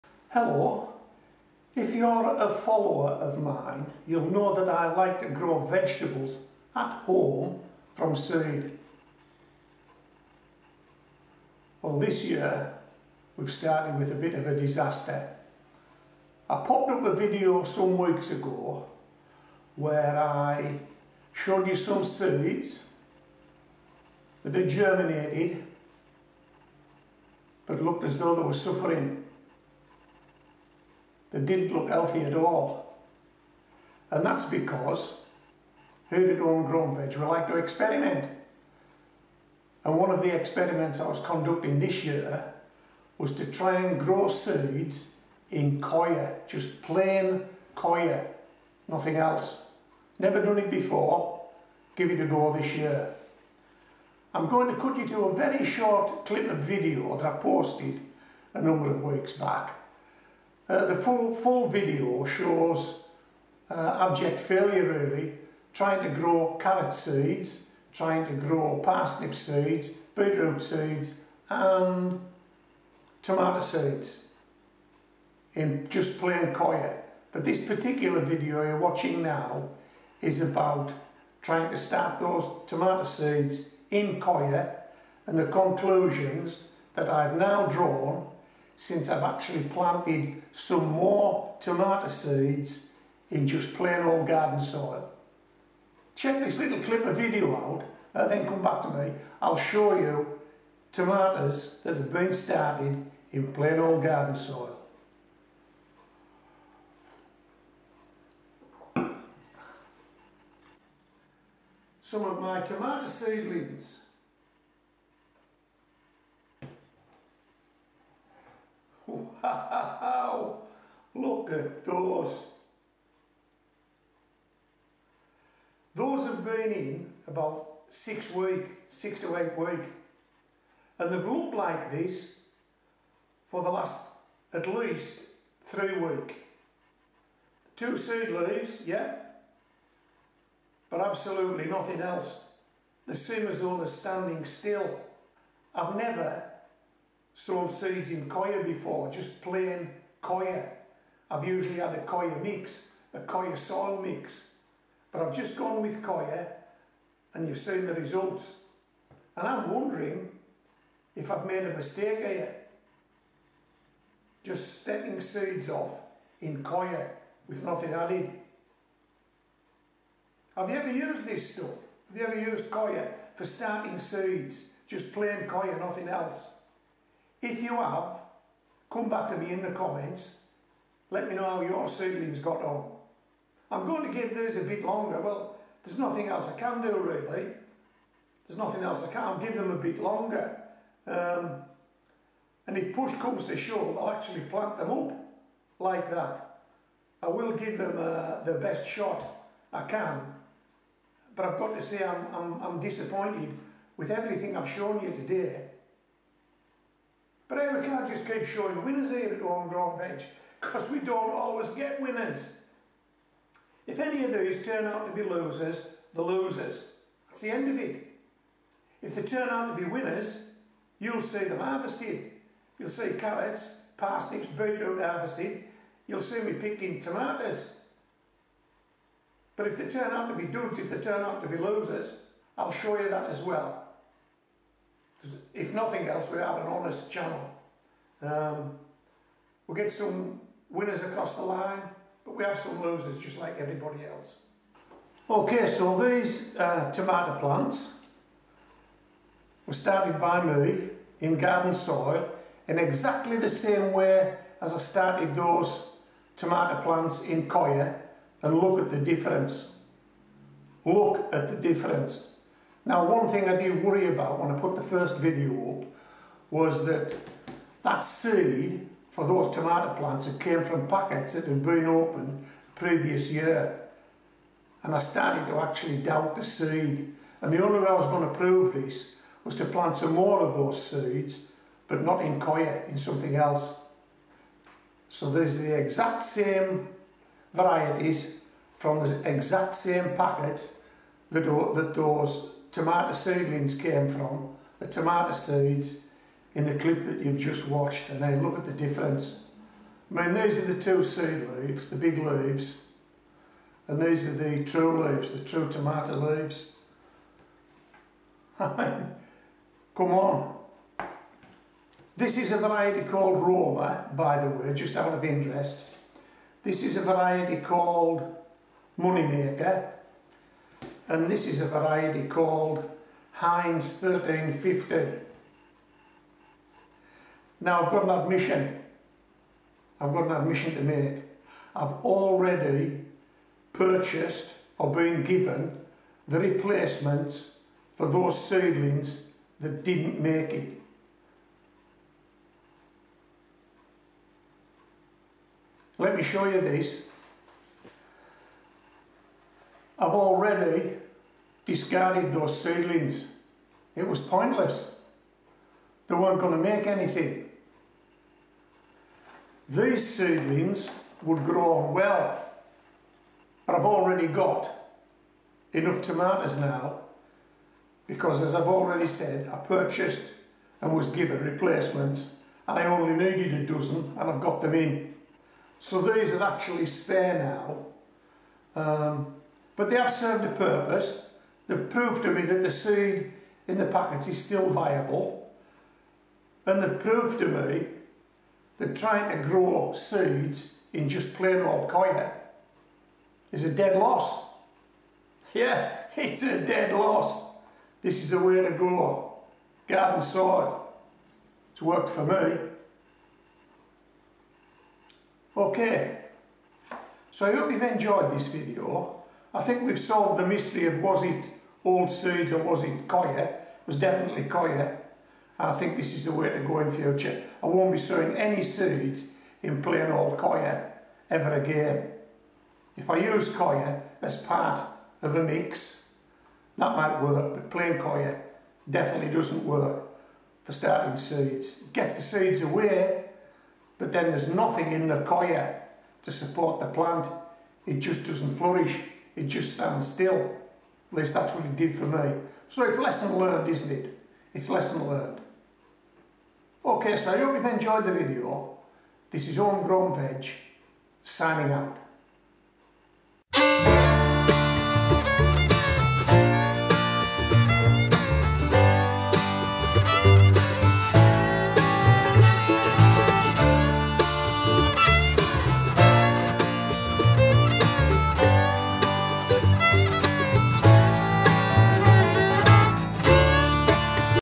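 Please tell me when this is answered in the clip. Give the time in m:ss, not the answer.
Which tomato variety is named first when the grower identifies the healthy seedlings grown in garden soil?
5:13.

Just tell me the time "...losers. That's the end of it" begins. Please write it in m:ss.
3:36.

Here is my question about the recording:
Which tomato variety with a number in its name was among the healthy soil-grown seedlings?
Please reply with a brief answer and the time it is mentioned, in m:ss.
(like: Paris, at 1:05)
Heinz 1350, at 5:23.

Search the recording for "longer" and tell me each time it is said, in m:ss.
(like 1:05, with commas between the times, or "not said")
3:04, 3:10.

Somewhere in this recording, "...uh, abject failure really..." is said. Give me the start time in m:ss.
1:03.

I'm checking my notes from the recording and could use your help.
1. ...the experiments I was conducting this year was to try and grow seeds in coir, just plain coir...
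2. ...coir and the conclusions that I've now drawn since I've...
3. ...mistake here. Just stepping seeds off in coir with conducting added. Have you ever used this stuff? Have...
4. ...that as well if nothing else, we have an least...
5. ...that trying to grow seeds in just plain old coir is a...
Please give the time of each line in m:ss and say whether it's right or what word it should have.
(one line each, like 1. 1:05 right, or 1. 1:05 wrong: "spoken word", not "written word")
1. 0:40 right
2. 1:24 right
3. 2:41 wrong: "nothing", not "conducting"
4. 3:53 wrong: "honest", not "least"
5. 6:28 right.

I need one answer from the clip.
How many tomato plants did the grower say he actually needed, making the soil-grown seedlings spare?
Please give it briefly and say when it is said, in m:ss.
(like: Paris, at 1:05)
12, at 6:13.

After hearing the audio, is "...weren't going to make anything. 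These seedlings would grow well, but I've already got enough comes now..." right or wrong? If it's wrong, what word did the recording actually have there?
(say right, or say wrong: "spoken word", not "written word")
wrong: "tomatoes", not "comes".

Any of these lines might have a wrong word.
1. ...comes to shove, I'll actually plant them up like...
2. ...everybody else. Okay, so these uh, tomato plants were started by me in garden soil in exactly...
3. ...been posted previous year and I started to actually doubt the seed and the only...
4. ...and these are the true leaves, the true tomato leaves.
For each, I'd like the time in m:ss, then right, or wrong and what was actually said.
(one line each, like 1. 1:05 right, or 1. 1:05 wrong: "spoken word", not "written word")
1. 3:13 right
2. 4:03 right
3. 4:31 wrong: "opened", not "posted"
4. 5:03 right.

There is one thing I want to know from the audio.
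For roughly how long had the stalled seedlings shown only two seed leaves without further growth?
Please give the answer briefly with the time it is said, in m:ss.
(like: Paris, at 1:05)
3 weeks, at 2:15.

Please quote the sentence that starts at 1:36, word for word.
Check this little clip of video out and then come back to me.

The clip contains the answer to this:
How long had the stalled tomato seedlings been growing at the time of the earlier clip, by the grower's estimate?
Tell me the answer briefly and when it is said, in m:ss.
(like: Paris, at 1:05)
6 to 8 weeks, at 2:08.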